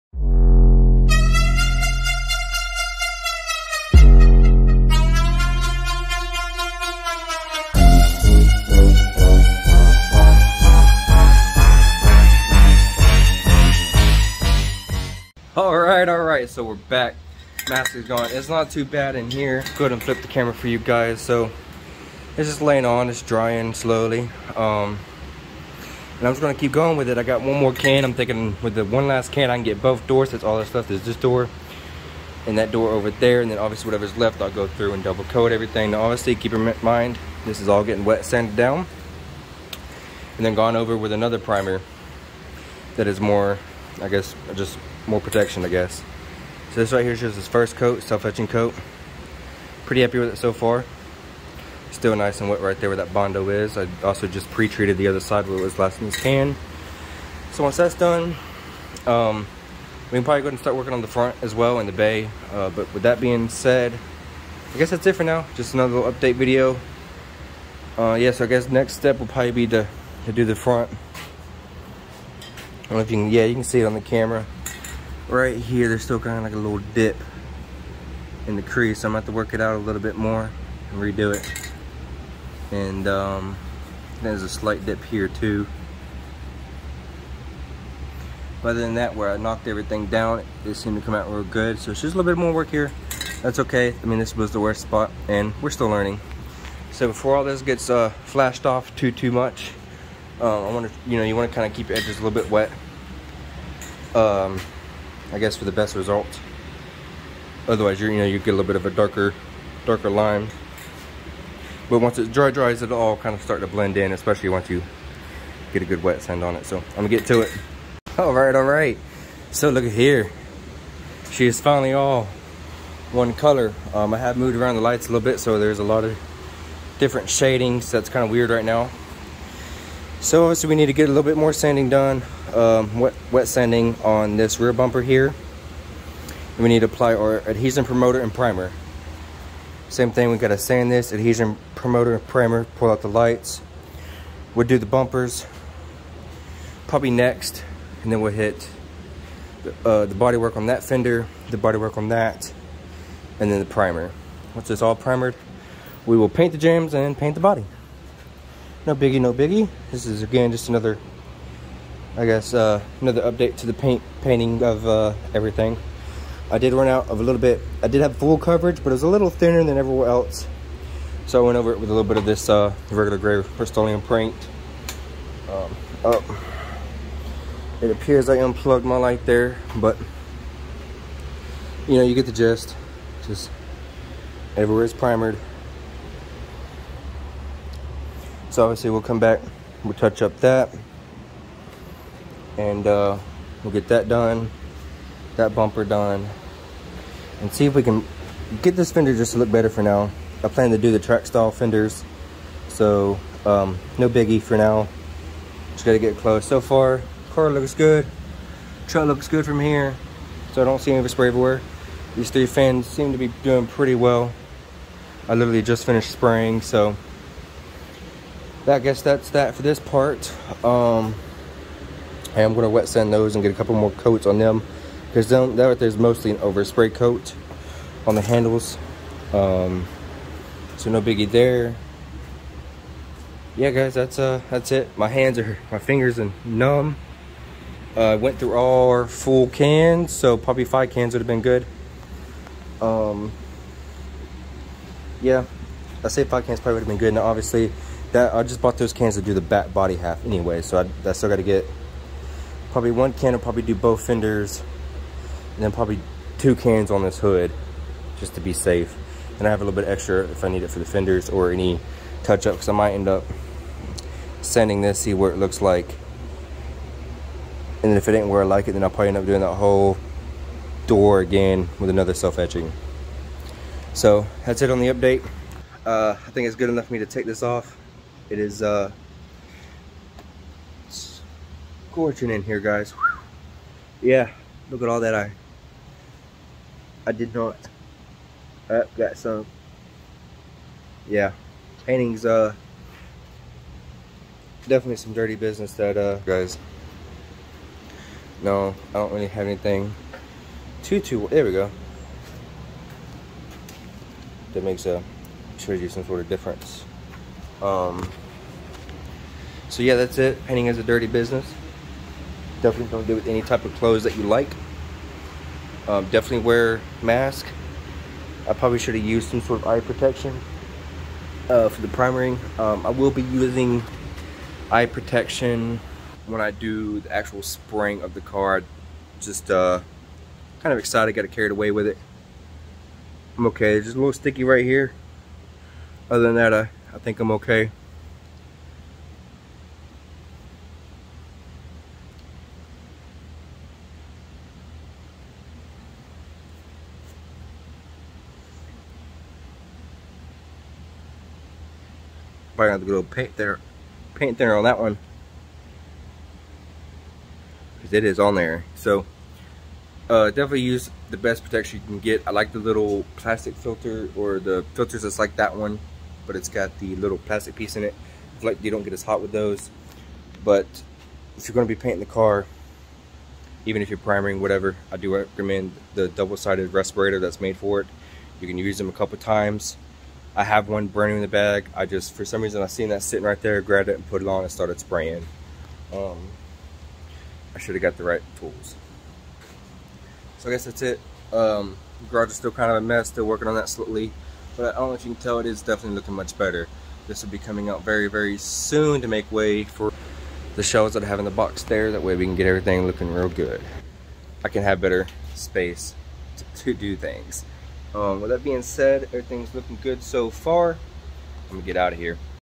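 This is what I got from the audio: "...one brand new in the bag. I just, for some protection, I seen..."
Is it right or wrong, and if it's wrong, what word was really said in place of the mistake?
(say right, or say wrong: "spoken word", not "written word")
wrong: "reason", not "protection".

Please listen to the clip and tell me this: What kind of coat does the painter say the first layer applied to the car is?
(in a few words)
self-etching coat.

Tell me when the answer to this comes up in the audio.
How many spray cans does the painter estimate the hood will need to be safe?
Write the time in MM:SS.
04:16.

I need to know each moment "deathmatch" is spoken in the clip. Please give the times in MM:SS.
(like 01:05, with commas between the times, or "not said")
not said.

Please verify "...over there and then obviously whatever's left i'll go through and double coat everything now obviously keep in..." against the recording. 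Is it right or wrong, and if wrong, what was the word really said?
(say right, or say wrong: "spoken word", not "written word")
right.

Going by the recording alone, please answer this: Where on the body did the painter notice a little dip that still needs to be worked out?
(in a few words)
in the crease.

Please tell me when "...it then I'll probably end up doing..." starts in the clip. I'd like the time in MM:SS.
04:28.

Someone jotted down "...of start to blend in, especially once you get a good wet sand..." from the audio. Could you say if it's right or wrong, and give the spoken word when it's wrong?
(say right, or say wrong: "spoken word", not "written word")
right.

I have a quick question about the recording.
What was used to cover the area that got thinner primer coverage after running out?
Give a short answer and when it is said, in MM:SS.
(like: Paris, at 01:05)
regular gray rust paint, at 02:52.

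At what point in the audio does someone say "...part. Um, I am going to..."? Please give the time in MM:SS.
03:39.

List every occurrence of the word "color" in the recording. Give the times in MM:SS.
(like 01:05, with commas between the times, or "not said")
02:03.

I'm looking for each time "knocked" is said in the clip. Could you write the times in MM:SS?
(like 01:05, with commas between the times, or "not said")
01:29.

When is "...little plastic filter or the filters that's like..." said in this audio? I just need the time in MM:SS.
06:02.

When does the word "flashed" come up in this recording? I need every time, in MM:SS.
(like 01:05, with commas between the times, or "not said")
01:38.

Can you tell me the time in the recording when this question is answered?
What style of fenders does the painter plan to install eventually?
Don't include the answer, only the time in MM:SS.
03:20.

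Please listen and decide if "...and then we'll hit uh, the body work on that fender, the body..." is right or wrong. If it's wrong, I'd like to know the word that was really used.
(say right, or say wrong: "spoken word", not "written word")
right.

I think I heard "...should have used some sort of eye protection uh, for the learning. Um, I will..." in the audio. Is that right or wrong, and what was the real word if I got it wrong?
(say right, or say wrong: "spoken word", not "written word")
wrong: "priming", not "learning".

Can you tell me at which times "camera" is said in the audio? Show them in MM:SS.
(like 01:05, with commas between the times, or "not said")
00:20, 01:14.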